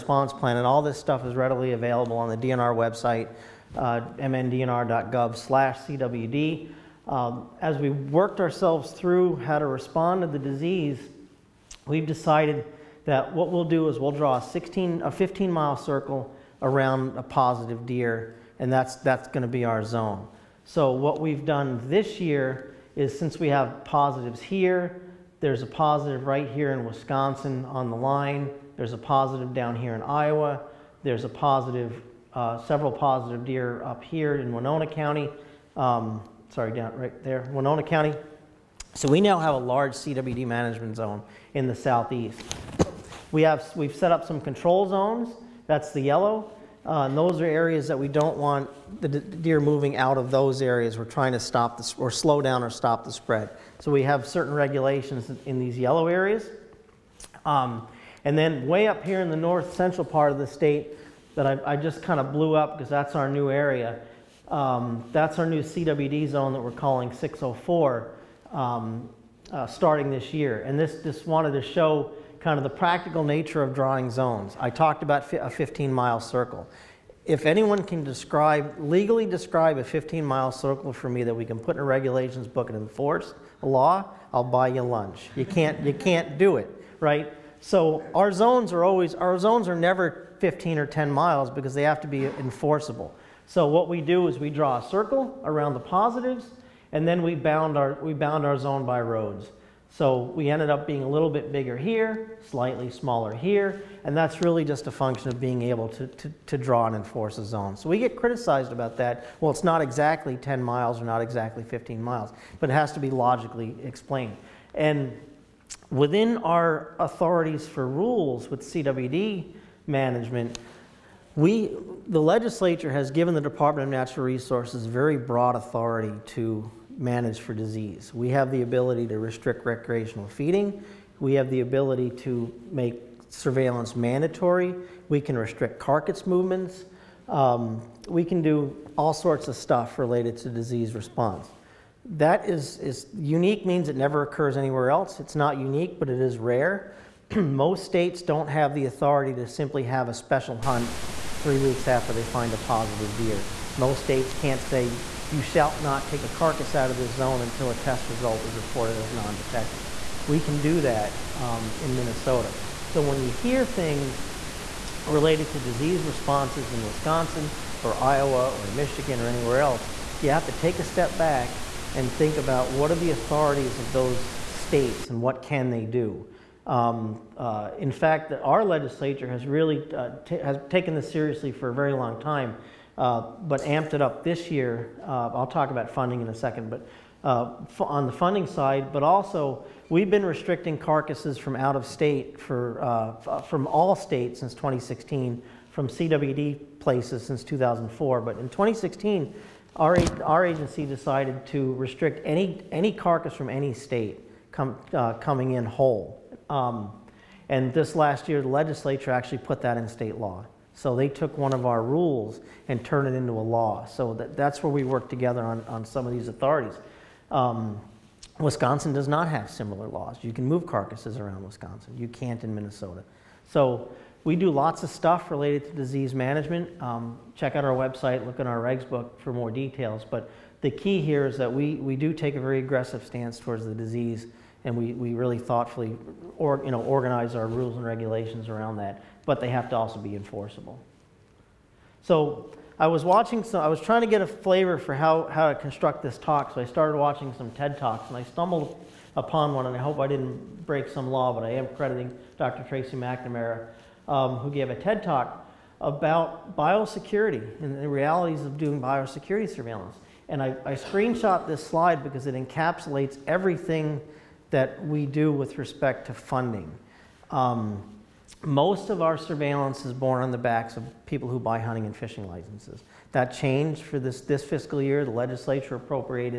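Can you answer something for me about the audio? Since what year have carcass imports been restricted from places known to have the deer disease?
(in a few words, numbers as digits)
2004.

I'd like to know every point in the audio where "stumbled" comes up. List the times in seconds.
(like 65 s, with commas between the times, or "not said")
248 s.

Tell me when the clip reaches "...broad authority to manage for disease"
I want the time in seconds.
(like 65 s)
125 s.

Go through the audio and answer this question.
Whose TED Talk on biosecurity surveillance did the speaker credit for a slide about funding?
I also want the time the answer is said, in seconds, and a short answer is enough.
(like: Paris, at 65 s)
Dr. Tracey McNamara, at 252 s.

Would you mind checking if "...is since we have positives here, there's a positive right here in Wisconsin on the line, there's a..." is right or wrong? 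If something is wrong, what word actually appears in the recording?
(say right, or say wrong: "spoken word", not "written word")
right.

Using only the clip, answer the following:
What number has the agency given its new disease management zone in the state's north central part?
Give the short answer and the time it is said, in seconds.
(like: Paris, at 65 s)
604, at 67 s.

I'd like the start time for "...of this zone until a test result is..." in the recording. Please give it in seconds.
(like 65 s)
156 s.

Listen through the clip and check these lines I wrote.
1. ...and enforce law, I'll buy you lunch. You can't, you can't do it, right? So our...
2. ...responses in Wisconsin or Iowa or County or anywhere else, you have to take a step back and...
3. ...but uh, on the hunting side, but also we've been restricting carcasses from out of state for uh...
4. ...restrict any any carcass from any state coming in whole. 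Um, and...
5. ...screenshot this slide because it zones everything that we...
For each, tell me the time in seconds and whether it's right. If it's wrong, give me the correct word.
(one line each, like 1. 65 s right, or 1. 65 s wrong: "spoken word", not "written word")
1. 82 s right
2. 166 s wrong: "Michigan", not "County"
3. 186 s wrong: "funding", not "hunting"
4. 201 s right
5. 260 s wrong: "encapsulates", not "zones".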